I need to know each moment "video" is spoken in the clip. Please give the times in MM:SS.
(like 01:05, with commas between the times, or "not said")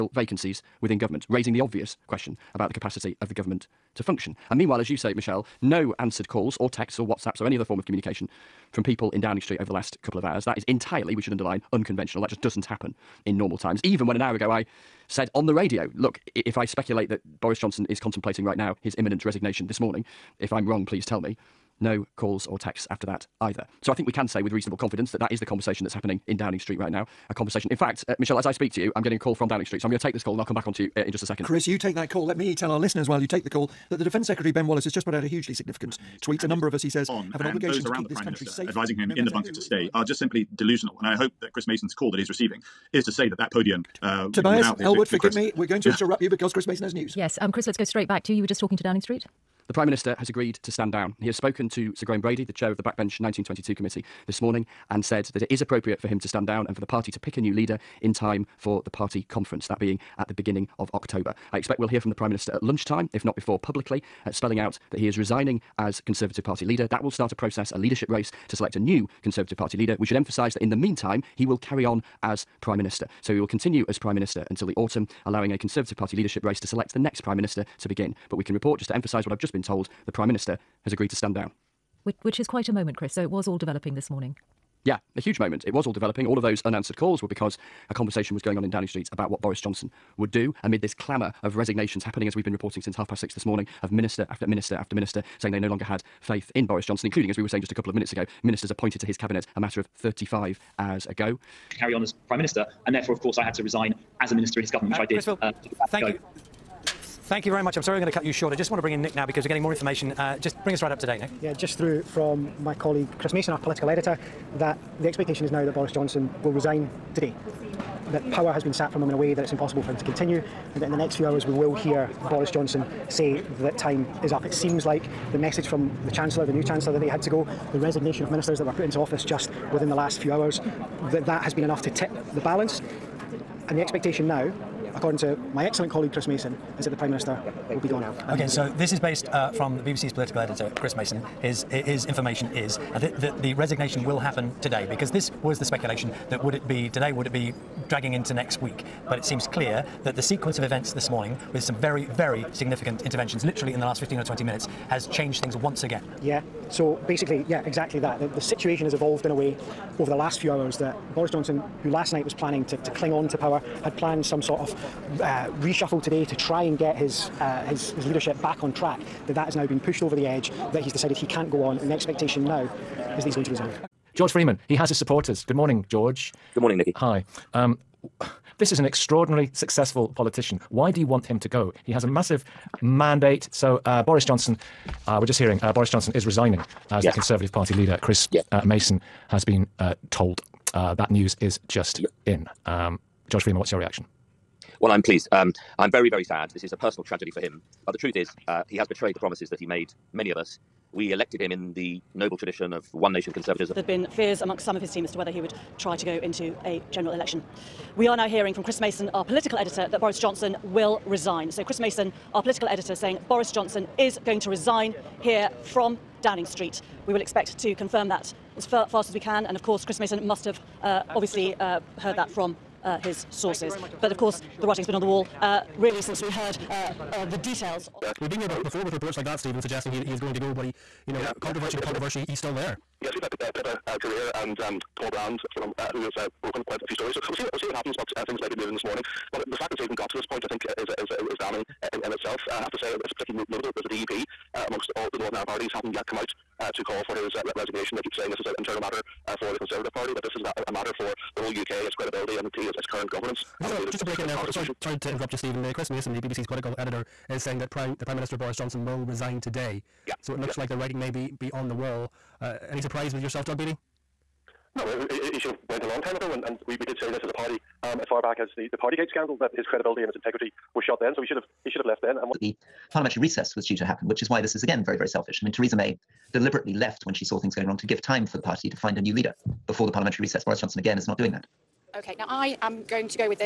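not said.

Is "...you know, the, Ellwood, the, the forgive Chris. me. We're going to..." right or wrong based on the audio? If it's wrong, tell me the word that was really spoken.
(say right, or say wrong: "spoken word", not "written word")
right.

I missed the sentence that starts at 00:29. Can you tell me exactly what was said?
So I'm going to take this call and I'll come back on to you uh, in just a second.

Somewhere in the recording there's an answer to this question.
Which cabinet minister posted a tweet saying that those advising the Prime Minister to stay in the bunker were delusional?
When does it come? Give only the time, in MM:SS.
00:34.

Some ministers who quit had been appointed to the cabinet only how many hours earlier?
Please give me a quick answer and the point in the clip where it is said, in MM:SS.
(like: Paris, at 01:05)
35, at 01:39.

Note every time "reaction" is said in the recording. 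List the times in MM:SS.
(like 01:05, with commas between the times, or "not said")
03:13.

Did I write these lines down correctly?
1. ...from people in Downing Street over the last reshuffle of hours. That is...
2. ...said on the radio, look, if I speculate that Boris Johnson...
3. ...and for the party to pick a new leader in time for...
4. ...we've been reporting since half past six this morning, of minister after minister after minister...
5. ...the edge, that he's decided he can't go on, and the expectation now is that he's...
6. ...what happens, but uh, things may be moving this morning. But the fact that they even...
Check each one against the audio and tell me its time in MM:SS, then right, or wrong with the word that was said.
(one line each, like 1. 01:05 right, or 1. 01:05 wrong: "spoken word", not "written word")
1. 00:08 wrong: "couple", not "reshuffle"
2. 00:15 right
3. 00:56 right
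4. 01:32 right
5. 02:50 right
6. 03:57 right.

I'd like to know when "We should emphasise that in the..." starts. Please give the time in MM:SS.
01:09.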